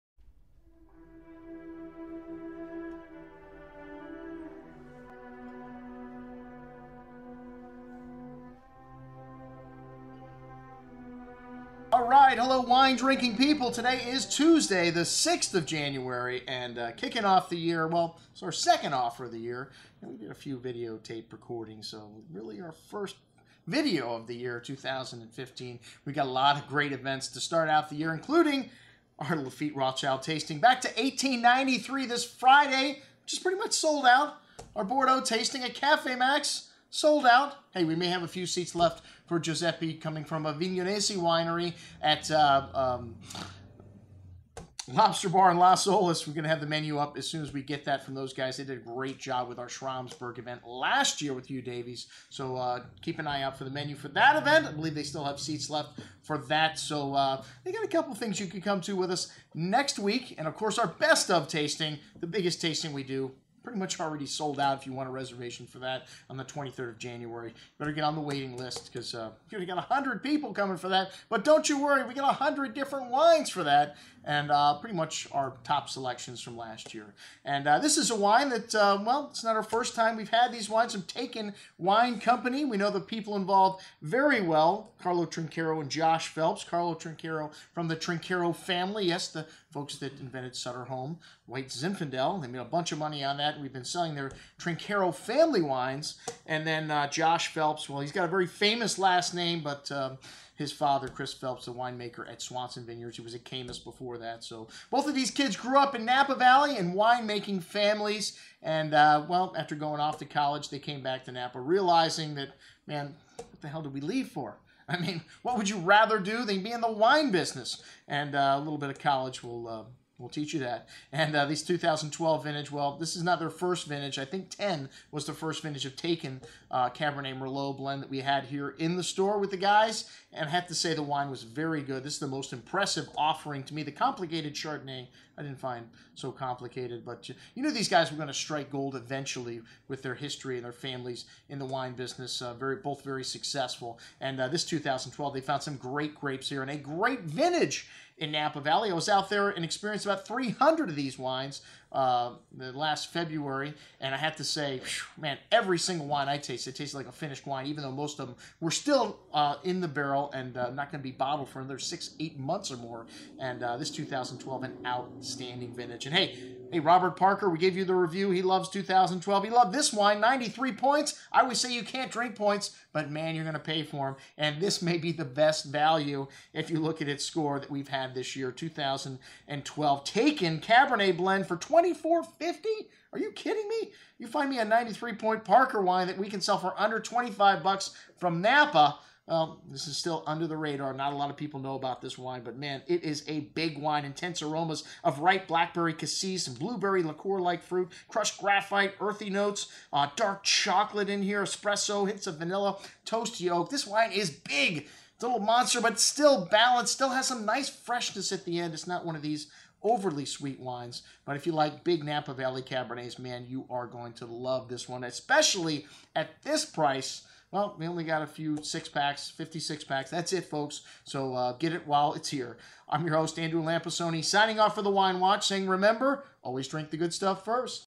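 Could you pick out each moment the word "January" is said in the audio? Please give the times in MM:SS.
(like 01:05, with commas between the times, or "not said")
00:15, 01:06.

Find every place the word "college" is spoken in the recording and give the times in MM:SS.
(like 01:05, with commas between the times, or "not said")
01:50, 01:58.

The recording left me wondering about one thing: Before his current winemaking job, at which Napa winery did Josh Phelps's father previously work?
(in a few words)
Caymus.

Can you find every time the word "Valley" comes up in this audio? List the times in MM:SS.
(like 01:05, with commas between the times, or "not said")
01:46, 02:28, 03:32.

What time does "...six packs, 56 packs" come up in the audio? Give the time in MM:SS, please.
03:38.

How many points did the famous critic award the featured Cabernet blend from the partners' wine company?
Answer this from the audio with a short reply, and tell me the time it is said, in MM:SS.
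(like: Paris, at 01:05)
93, at 02:50.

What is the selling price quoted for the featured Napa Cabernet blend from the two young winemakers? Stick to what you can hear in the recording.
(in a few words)
$24.50.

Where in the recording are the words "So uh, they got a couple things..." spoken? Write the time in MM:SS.
00:56.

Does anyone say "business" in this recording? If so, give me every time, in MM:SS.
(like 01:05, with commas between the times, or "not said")
01:57, 02:21.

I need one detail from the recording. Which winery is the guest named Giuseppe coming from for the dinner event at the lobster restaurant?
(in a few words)
Avignonesi.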